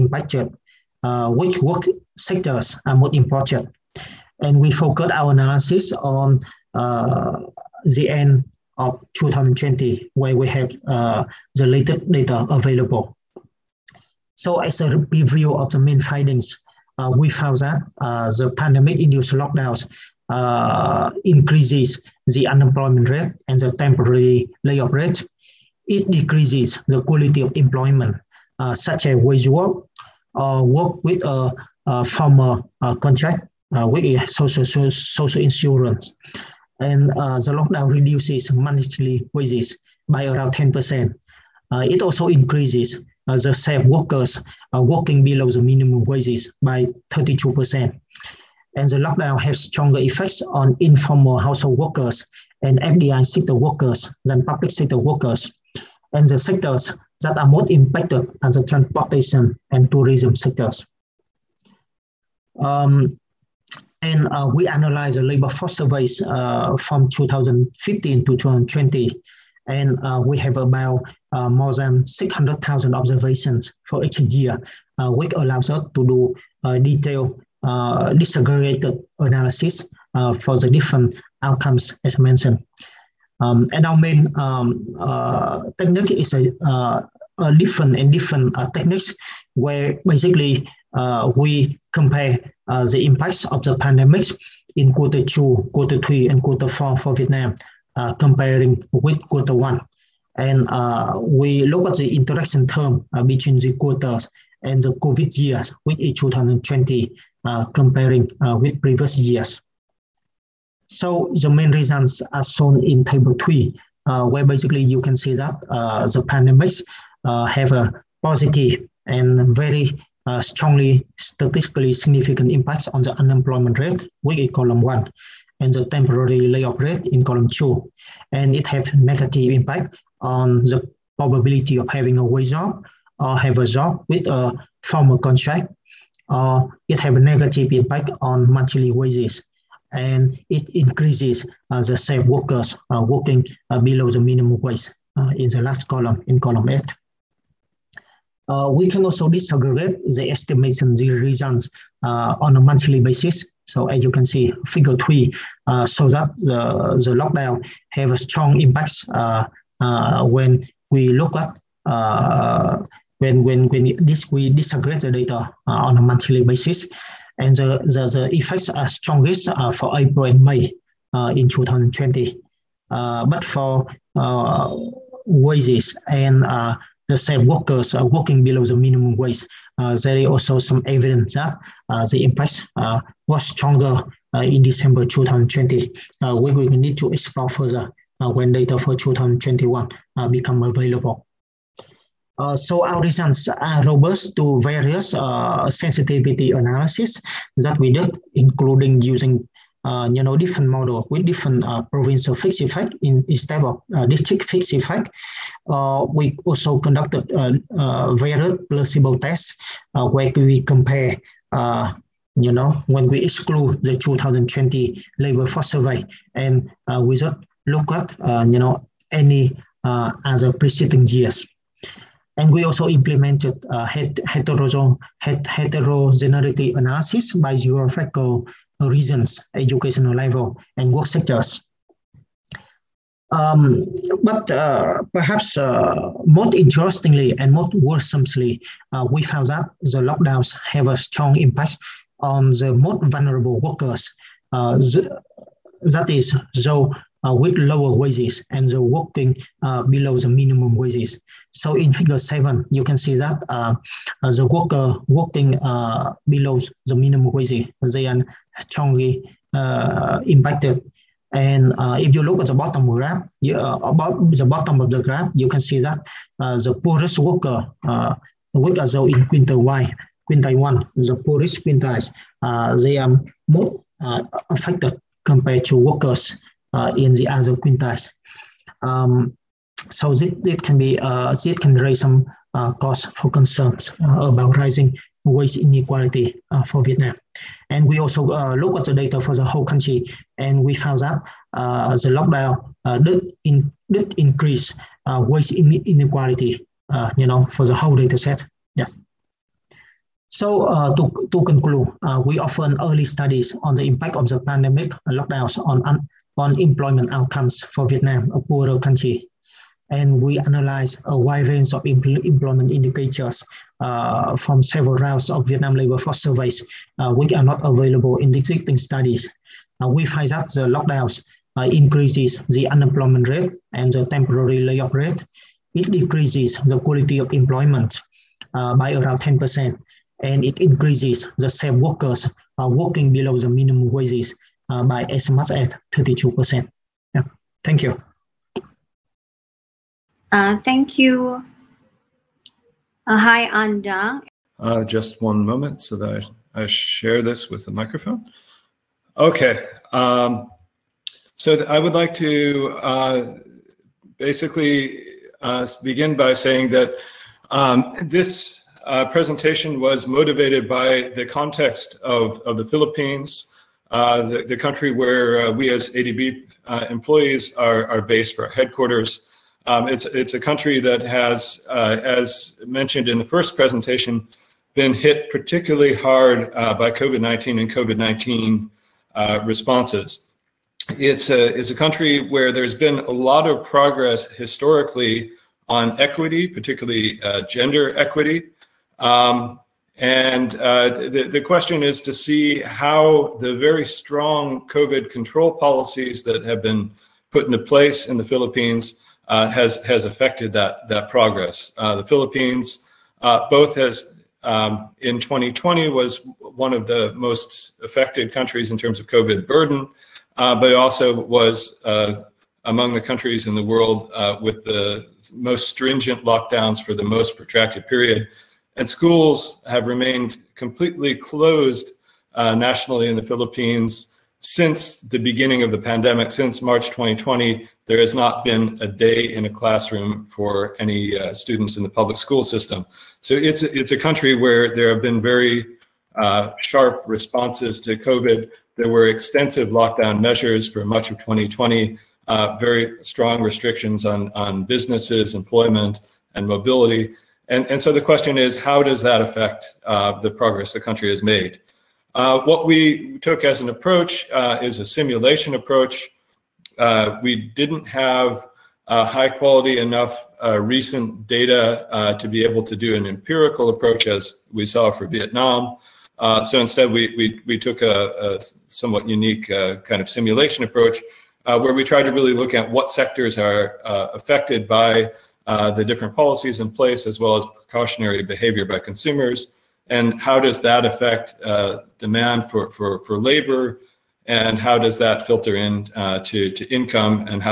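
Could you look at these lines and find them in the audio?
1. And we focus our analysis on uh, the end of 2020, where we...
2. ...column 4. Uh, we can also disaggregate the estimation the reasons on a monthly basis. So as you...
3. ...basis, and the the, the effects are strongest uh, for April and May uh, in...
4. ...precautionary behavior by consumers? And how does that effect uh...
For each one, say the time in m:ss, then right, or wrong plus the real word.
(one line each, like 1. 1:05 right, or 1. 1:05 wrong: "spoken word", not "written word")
1. 0:04 right
2. 2:26 wrong: "8", not "4"
3. 2:46 right
4. 7:57 wrong: "affect", not "effect".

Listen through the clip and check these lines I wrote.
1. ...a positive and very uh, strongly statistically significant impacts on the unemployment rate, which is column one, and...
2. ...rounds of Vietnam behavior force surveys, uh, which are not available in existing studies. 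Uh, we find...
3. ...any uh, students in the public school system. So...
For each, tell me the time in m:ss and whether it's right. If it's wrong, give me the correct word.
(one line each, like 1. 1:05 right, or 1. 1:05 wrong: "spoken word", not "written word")
1. 1:57 right
2. 5:14 wrong: "labor", not "behavior"
3. 7:10 right.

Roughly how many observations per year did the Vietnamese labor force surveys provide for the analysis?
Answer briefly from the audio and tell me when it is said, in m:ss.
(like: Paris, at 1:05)
More than 600,000, at 1:11.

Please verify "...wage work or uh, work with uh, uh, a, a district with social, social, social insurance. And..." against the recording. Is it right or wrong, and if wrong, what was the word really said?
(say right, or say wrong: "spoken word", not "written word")
wrong: "contract", not "district".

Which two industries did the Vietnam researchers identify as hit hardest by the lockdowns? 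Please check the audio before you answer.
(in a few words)
Transportation and tourism.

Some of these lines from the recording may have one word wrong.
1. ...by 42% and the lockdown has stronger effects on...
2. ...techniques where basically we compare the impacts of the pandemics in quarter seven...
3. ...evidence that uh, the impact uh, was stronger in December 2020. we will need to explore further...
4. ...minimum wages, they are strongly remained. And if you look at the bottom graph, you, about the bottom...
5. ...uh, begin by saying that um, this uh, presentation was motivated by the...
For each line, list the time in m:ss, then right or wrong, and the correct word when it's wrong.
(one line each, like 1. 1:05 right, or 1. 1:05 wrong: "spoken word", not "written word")
1. 0:46 wrong: "32", not "42"
2. 1:28 wrong: "two", not "seven"
3. 3:00 right
4. 4:16 wrong: "impacted", not "remained"
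5. 5:55 right.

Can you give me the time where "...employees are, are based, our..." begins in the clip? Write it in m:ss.
6:06.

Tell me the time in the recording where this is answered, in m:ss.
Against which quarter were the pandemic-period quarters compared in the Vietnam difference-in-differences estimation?
1:39.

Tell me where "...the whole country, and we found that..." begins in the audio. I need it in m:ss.
4:49.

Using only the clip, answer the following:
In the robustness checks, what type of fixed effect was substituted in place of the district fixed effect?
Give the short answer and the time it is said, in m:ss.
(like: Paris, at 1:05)
Provincial fixed effect, at 3:21.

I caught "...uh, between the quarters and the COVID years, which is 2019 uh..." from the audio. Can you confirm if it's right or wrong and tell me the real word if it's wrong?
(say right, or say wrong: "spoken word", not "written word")
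wrong: "2020", not "2019".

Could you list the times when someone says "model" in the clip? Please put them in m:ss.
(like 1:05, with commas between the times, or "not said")
3:20.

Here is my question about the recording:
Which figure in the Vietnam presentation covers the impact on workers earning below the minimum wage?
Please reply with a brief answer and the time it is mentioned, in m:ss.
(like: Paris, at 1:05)
Figure 7, at 4:11.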